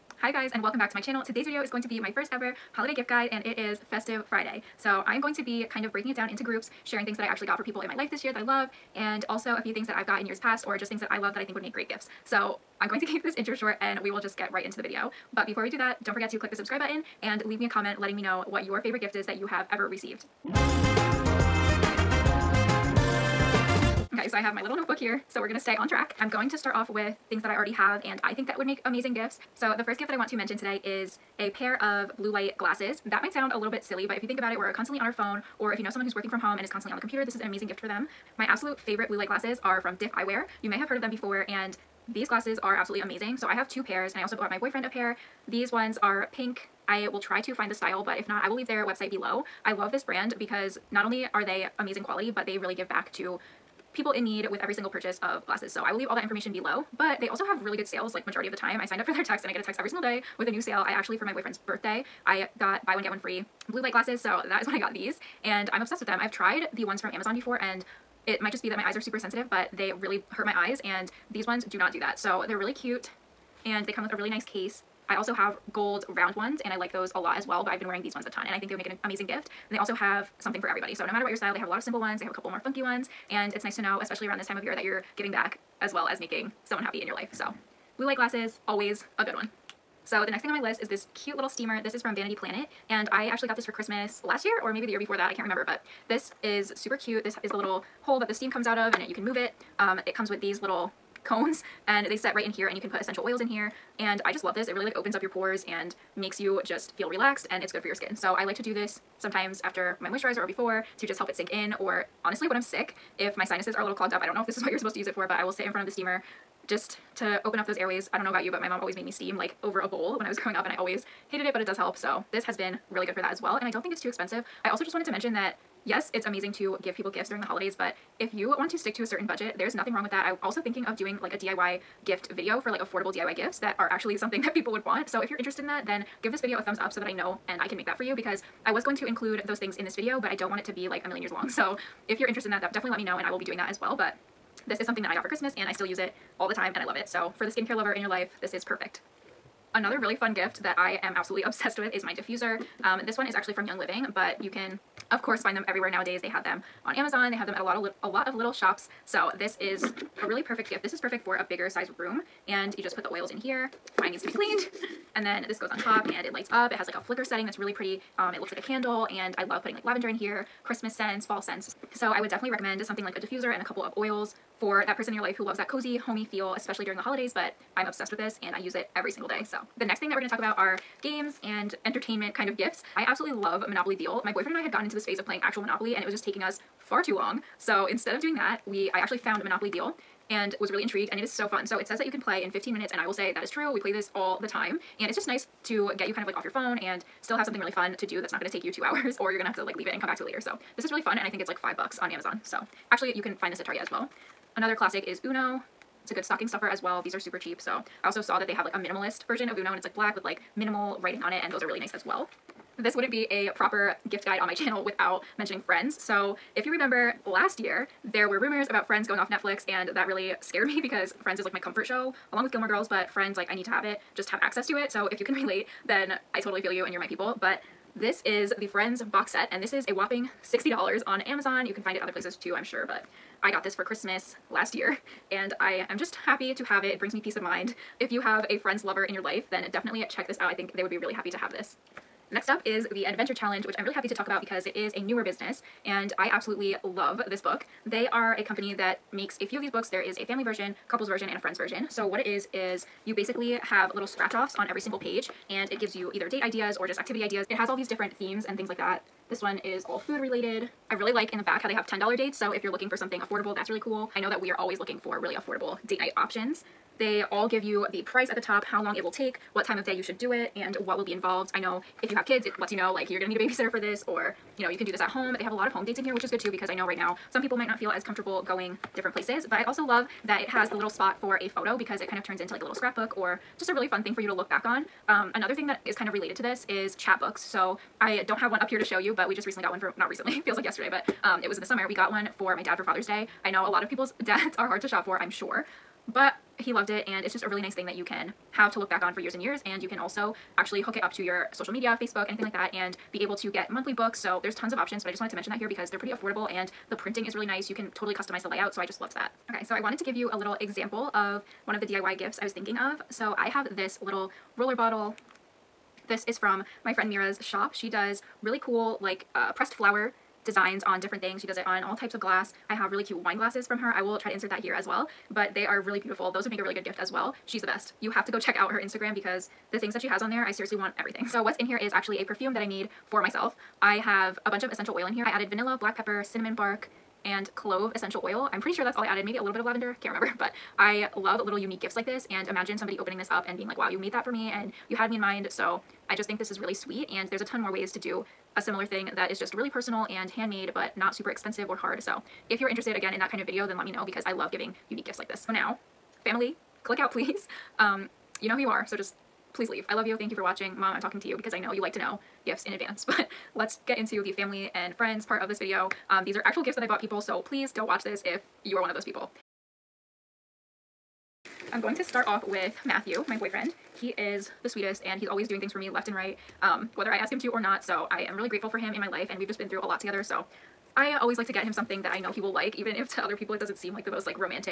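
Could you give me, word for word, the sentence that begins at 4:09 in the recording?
There is a family version, couples version, and a friends version.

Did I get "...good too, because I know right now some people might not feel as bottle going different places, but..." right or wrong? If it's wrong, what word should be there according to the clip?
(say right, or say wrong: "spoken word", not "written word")
wrong: "comfortable", not "bottle".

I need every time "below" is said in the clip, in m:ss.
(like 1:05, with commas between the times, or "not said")
0:49, 0:56.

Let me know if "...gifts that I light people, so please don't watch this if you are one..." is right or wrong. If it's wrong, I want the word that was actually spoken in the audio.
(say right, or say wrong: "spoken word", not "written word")
wrong: "bought", not "light".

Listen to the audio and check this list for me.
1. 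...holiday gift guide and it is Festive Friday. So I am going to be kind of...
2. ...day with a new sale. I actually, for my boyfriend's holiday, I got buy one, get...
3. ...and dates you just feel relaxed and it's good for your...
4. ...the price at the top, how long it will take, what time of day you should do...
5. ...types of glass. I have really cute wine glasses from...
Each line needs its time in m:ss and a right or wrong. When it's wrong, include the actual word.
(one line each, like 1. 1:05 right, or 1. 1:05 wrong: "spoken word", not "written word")
1. 0:02 right
2. 1:00 wrong: "birthday", not "holiday"
3. 1:45 wrong: "makes", not "dates"
4. 4:27 right
5. 5:21 right.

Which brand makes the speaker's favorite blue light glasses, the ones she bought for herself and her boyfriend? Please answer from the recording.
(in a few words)
Diff Eyewear.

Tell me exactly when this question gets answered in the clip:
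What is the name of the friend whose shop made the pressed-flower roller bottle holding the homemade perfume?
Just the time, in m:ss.
5:17.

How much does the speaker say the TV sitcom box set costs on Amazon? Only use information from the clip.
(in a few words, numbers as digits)
$60.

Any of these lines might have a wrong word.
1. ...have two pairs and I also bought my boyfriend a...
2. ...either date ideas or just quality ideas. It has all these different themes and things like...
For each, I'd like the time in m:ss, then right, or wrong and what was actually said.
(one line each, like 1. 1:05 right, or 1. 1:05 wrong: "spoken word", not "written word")
1. 0:43 right
2. 4:16 wrong: "activity", not "quality".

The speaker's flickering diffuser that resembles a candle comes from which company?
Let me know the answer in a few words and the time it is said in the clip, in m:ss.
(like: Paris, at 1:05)
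Young Living, at 2:33.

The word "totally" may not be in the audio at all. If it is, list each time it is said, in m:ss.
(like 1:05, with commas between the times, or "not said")
3:46, 5:07.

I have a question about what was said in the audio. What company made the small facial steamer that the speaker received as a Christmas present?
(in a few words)
Vanity Planet.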